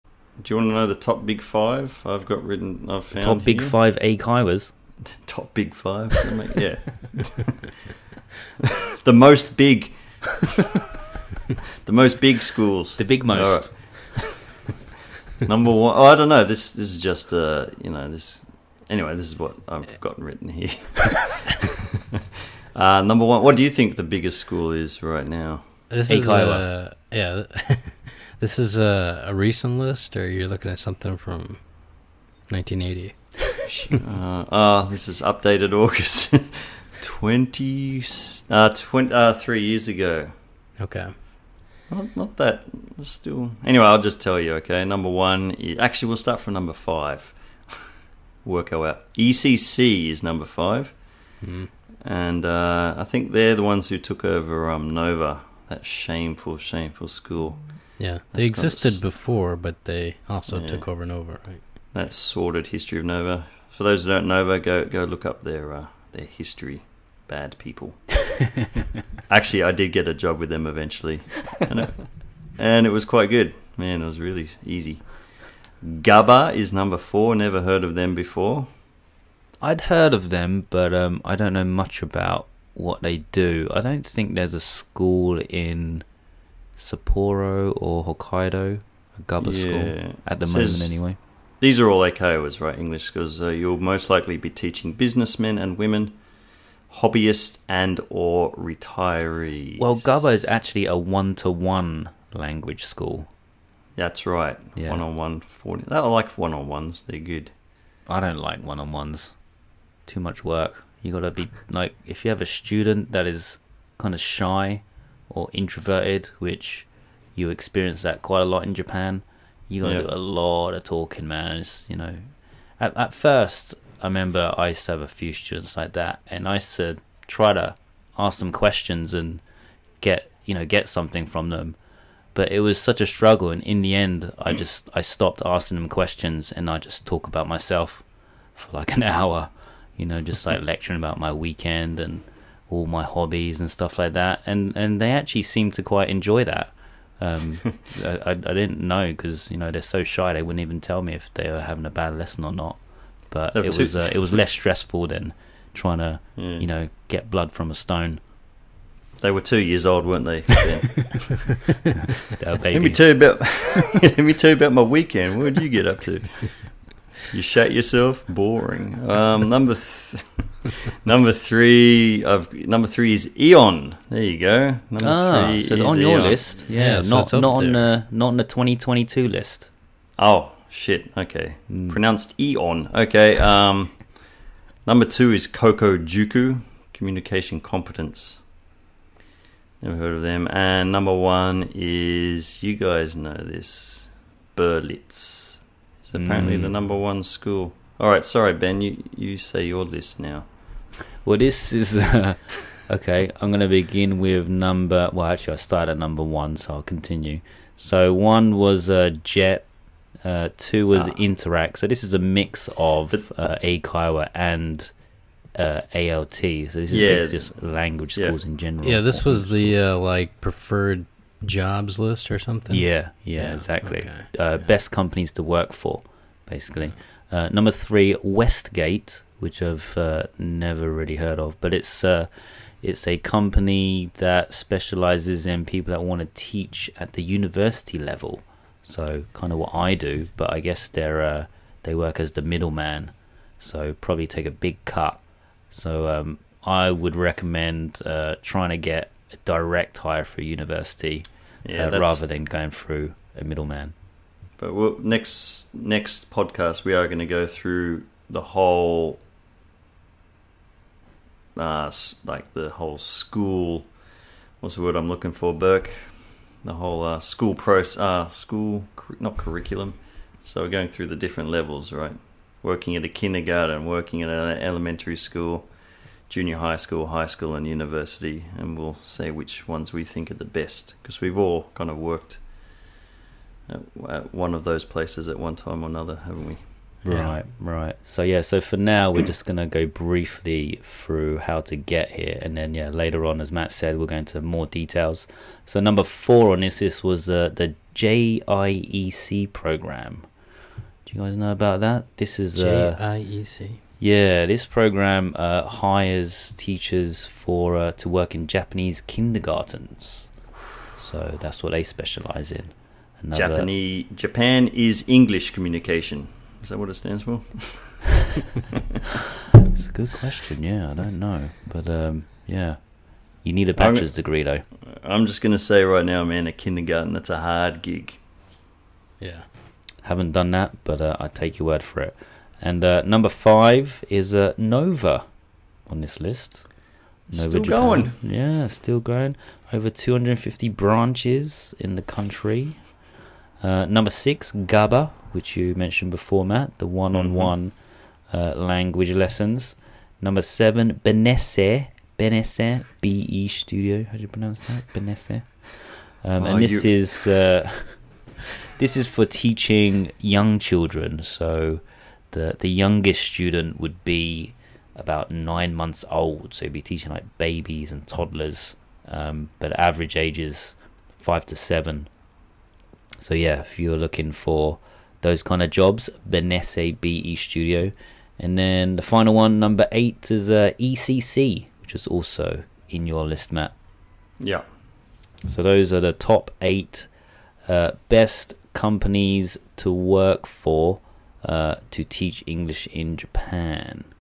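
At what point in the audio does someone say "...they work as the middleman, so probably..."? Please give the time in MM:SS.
04:01.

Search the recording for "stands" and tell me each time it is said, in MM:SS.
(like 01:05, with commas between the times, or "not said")
05:16.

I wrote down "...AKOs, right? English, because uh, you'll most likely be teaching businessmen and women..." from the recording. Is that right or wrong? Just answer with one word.
right.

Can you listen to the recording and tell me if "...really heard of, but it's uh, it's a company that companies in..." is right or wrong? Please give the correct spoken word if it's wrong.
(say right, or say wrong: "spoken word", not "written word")
wrong: "specializes", not "companies".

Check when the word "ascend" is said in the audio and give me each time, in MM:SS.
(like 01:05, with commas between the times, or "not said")
not said.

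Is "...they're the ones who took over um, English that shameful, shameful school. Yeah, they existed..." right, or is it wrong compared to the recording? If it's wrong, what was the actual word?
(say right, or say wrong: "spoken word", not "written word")
wrong: "Nova", not "English".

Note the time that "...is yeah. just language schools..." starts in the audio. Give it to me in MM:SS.
03:36.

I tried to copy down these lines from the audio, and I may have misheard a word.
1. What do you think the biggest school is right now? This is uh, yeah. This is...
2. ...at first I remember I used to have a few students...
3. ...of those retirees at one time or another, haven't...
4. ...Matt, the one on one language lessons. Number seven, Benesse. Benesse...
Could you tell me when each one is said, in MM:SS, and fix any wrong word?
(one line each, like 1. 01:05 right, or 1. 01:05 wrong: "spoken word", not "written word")
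1. 00:23 right
2. 02:02 right
3. 04:44 wrong: "places", not "retirees"
4. 05:46 right.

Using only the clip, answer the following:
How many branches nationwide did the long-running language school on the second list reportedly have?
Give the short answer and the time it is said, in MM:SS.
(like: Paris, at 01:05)
Over 250, at 05:39.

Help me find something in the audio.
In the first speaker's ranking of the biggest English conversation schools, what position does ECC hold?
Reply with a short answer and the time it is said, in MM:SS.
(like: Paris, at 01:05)
5, at 00:49.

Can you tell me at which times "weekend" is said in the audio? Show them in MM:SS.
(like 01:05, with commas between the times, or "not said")
02:21, 02:44.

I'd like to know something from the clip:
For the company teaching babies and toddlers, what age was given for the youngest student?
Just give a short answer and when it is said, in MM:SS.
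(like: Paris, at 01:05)
9 months, at 06:05.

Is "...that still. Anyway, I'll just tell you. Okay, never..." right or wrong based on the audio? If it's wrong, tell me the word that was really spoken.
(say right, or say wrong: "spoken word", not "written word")
wrong: "number", not "never".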